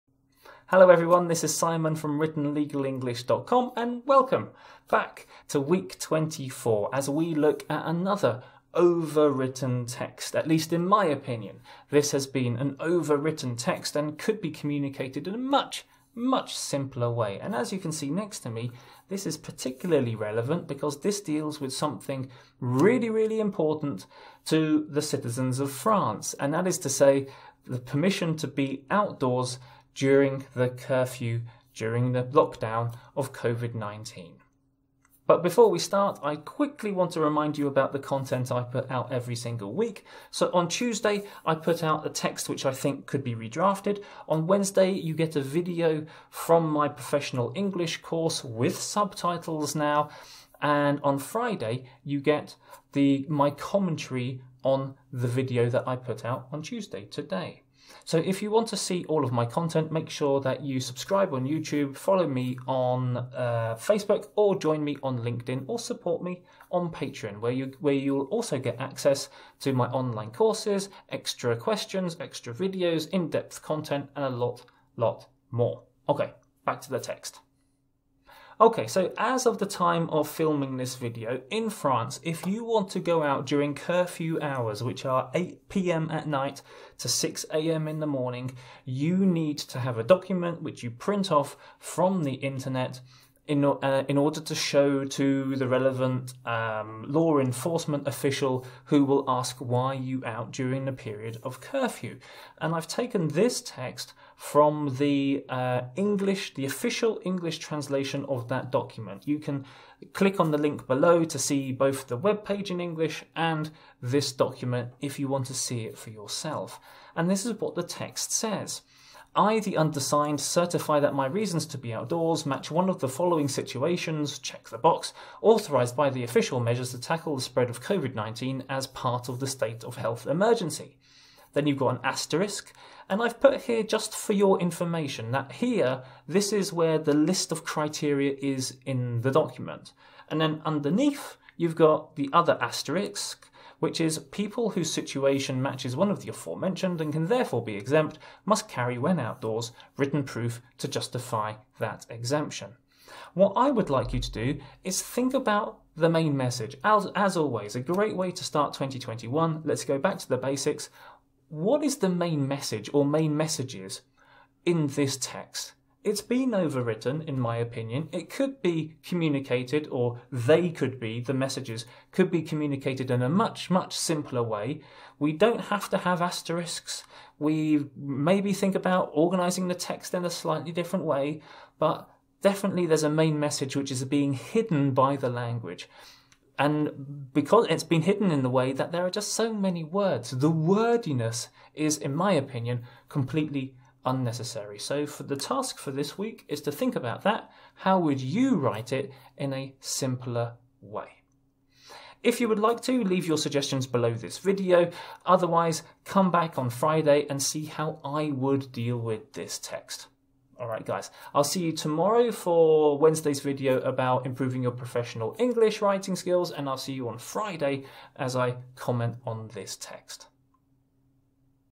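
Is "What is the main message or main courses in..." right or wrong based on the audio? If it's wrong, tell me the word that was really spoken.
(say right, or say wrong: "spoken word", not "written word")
wrong: "messages", not "courses".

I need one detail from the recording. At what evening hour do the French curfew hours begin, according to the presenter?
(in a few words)
8 pm.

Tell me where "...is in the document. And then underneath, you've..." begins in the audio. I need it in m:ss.
2:18.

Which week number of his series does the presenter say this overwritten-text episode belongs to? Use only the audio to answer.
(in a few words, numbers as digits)
24.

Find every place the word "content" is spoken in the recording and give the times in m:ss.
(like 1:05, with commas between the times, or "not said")
0:37, 0:59, 1:13.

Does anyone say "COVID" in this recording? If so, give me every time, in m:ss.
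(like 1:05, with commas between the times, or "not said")
0:33, 2:07.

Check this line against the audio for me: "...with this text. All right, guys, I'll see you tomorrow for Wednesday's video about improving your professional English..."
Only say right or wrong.
right.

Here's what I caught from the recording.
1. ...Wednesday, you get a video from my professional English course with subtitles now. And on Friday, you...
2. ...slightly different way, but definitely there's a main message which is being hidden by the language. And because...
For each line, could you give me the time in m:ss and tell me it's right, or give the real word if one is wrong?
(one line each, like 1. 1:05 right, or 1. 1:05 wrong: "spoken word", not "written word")
1. 0:44 right
2. 3:00 right.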